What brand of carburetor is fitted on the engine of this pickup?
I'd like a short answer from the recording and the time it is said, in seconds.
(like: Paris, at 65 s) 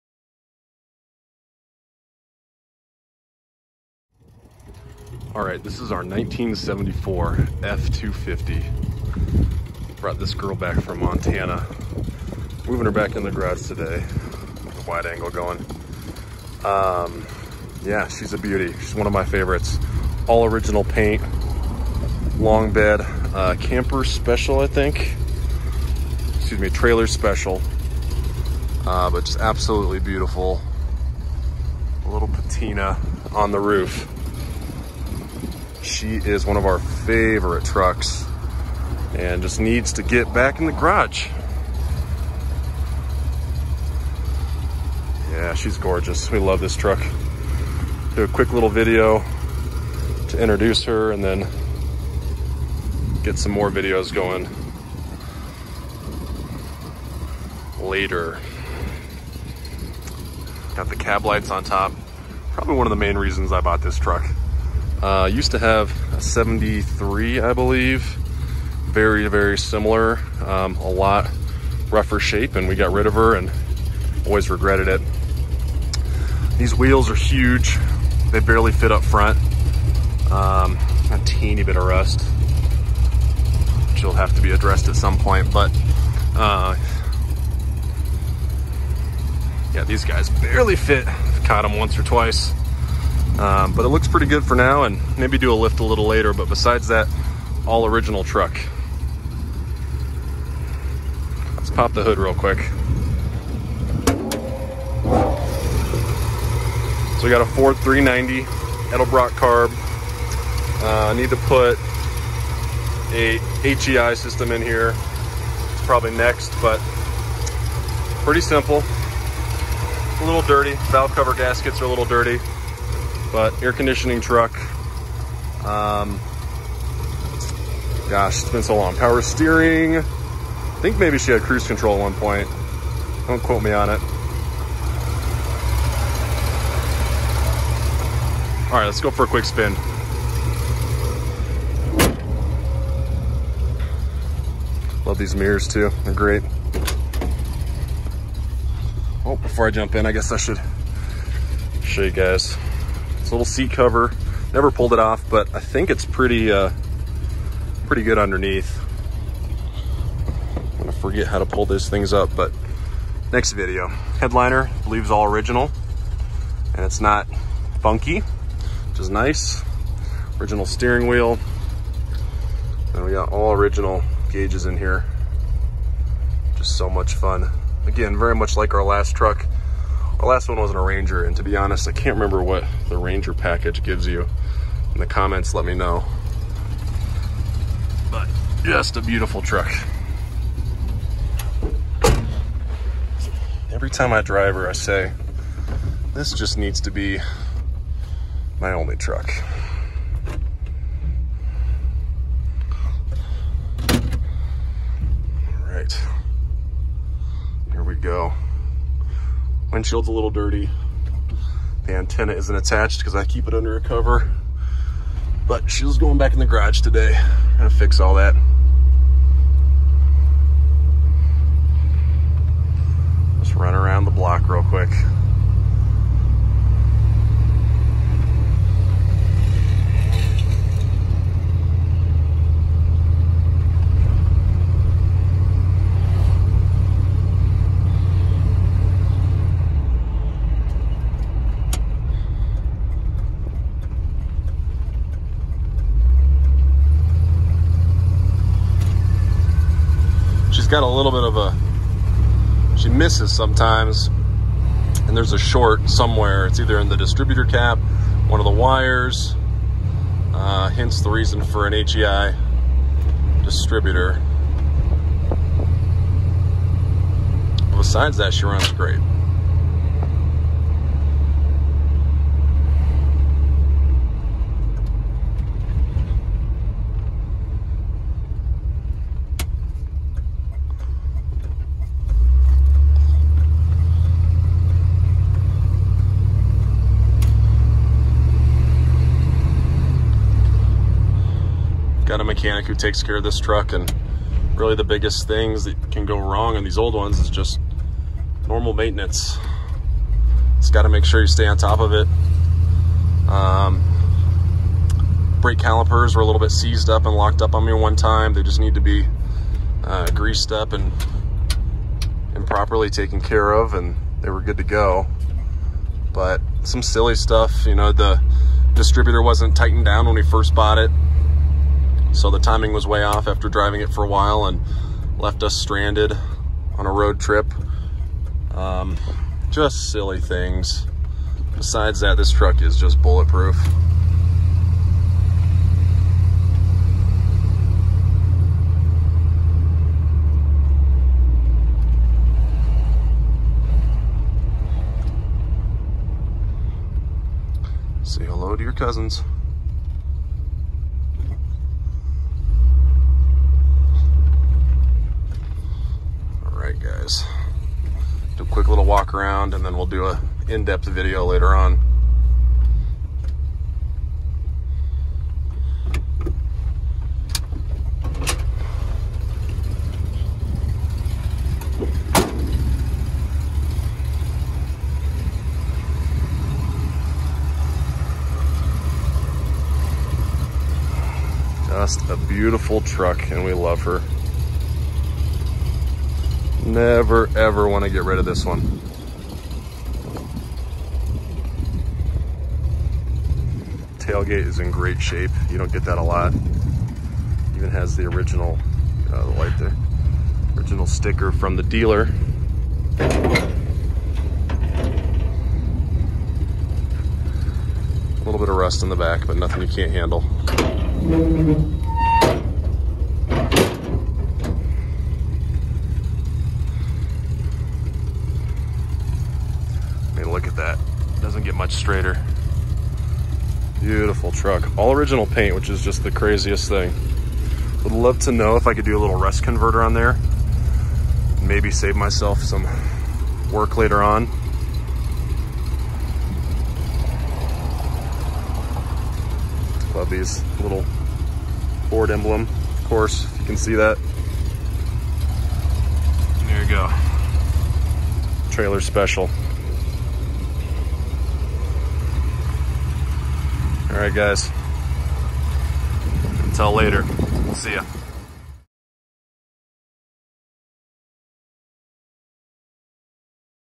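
Edelbrock, at 108 s.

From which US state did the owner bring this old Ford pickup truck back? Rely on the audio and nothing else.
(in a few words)
Montana.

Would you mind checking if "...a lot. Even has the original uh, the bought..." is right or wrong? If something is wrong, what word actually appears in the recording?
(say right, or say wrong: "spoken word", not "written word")
wrong: "light", not "bought".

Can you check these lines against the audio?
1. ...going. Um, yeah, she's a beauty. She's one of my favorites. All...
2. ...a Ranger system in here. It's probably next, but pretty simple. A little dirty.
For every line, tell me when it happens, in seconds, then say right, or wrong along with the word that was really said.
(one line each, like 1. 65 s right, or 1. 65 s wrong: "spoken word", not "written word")
1. 15 s right
2. 113 s wrong: "HEI", not "Ranger".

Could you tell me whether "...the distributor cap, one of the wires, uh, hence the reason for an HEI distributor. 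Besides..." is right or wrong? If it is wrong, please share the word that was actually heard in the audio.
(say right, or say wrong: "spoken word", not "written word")
right.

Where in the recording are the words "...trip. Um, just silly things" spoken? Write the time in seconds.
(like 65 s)
327 s.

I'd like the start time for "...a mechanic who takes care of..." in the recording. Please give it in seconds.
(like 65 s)
292 s.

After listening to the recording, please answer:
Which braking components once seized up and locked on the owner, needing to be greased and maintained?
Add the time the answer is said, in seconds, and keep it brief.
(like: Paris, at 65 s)
Brake calipers, at 305 s.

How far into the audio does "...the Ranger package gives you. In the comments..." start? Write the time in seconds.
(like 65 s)
182 s.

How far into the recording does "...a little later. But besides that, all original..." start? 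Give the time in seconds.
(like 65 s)
95 s.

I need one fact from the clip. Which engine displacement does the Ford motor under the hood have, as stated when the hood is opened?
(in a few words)
390.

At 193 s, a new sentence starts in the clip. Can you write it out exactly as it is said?
Every time I drive her, I say, this just needs to be my only truck.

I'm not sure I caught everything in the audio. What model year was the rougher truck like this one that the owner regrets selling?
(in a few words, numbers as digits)
1973.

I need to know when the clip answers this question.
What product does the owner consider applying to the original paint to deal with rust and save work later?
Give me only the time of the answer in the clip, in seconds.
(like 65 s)
429 s.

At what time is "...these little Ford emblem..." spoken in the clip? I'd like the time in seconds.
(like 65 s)
440 s.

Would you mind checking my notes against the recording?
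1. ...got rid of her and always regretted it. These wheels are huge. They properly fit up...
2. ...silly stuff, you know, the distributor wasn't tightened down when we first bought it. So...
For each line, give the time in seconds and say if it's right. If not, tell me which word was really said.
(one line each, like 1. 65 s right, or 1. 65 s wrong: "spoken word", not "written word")
1. 72 s wrong: "barely", not "properly"
2. 316 s right.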